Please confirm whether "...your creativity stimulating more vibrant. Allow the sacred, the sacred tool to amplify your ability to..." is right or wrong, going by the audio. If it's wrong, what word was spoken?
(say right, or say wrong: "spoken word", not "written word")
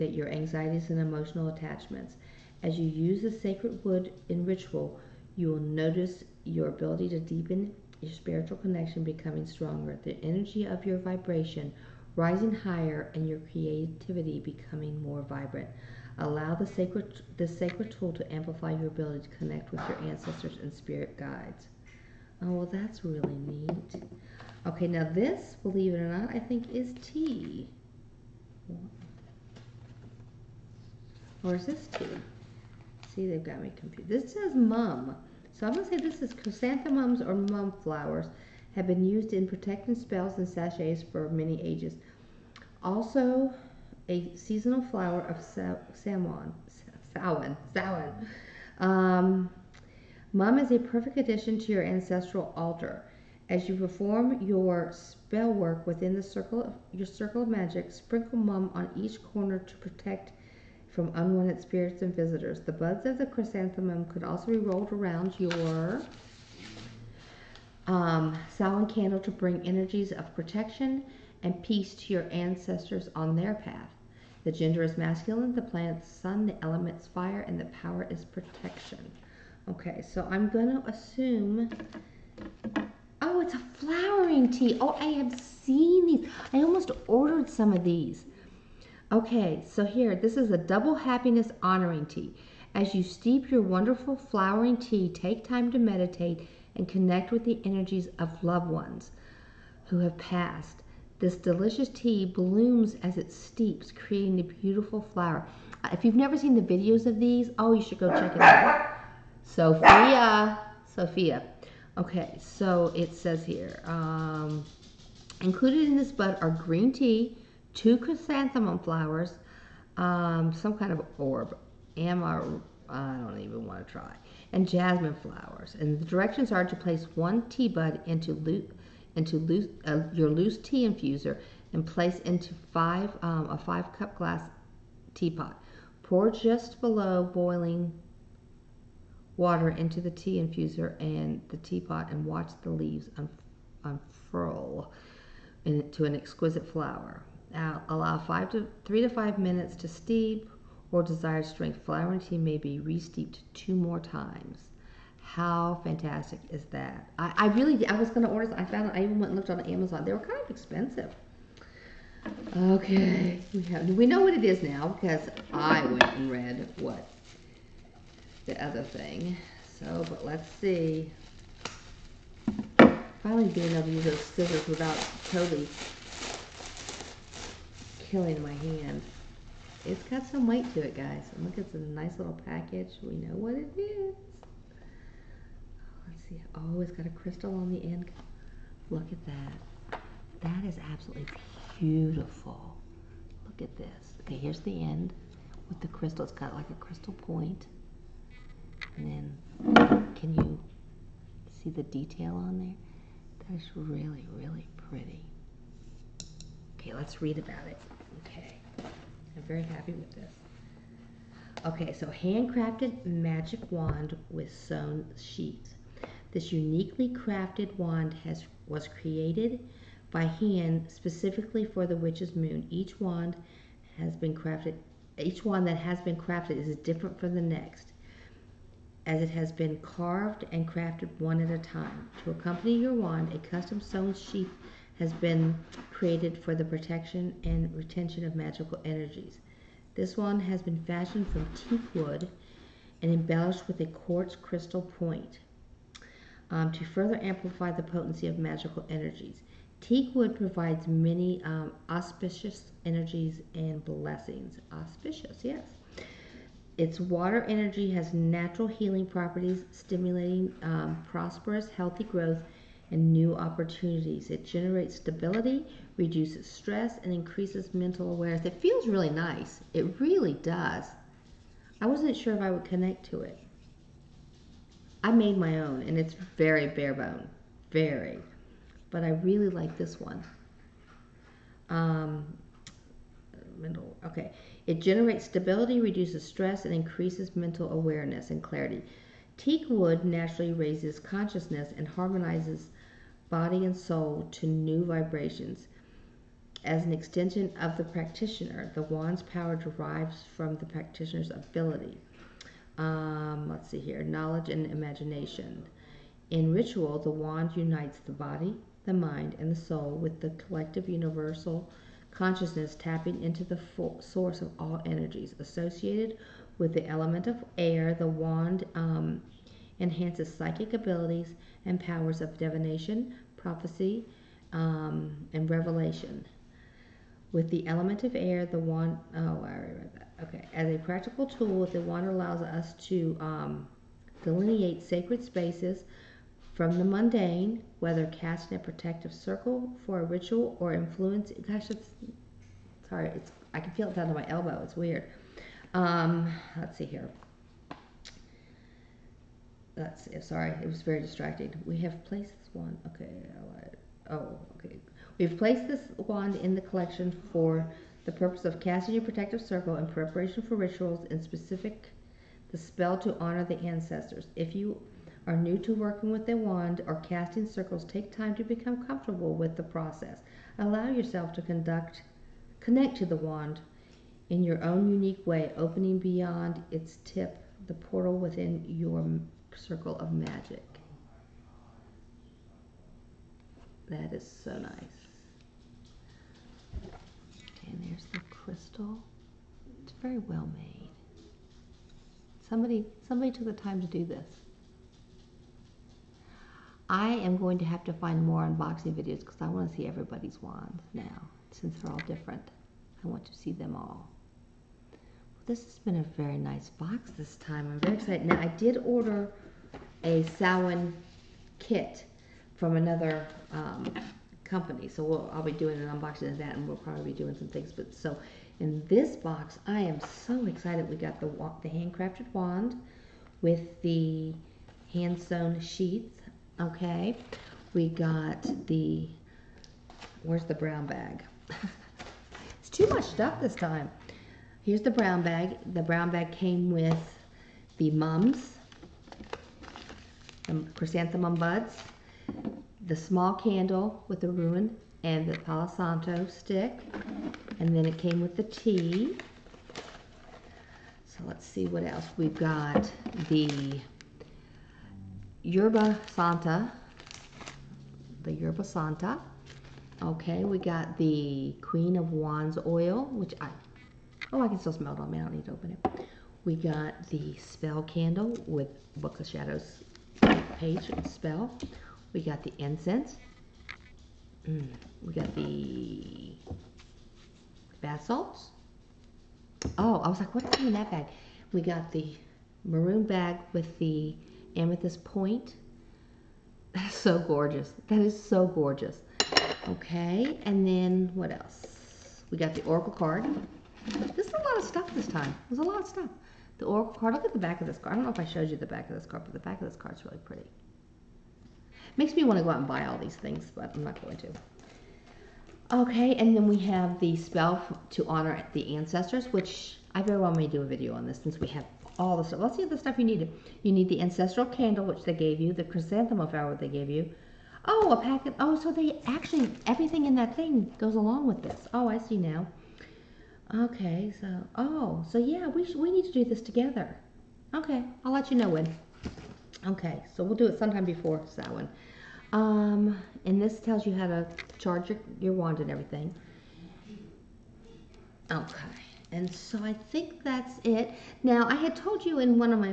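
wrong: "becoming", not "stimulating".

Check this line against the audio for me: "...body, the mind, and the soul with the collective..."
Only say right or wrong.
right.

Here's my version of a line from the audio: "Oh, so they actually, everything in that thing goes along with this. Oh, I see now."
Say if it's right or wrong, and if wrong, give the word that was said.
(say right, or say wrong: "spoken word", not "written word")
right.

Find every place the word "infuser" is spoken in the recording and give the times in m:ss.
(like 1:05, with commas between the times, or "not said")
2:10, 2:20.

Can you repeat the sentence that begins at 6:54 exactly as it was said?
So we'll, I'll be doing an unboxing of that, and we'll probably be doing some things.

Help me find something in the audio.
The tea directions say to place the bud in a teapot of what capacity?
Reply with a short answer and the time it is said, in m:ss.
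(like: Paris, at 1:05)
5 cup, at 2:13.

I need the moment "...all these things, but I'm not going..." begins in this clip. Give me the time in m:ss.
8:22.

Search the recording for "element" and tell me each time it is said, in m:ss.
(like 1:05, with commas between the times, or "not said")
1:16, 5:16, 5:27.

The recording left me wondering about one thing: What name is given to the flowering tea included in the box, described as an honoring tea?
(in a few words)
Double happiness.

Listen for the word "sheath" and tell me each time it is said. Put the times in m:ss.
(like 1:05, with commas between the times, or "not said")
3:35, 3:54, 7:05.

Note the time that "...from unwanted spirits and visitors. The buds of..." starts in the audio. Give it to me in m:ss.
1:00.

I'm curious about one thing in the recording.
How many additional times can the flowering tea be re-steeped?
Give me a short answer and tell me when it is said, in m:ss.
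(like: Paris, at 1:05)
2, at 2:33.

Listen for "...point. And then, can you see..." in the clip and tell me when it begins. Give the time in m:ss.
3:17.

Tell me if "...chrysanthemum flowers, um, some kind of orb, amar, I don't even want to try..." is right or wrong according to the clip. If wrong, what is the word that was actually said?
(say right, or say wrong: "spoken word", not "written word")
right.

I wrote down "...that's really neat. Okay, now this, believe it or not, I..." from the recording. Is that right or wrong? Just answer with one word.
right.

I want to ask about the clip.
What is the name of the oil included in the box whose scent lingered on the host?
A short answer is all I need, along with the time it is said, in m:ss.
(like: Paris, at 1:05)
Queen of Wands, at 7:41.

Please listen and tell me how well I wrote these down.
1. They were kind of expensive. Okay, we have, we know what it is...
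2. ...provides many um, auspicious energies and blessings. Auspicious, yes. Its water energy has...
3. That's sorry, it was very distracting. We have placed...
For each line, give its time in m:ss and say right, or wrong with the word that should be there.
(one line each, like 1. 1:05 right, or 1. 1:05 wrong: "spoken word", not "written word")
1. 2:40 right
2. 4:10 right
3. 5:49 right.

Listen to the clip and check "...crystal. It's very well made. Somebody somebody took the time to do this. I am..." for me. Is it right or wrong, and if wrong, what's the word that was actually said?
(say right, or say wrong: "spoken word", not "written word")
right.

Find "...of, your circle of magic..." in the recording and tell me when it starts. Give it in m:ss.
0:56.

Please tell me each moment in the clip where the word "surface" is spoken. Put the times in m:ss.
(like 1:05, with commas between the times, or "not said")
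not said.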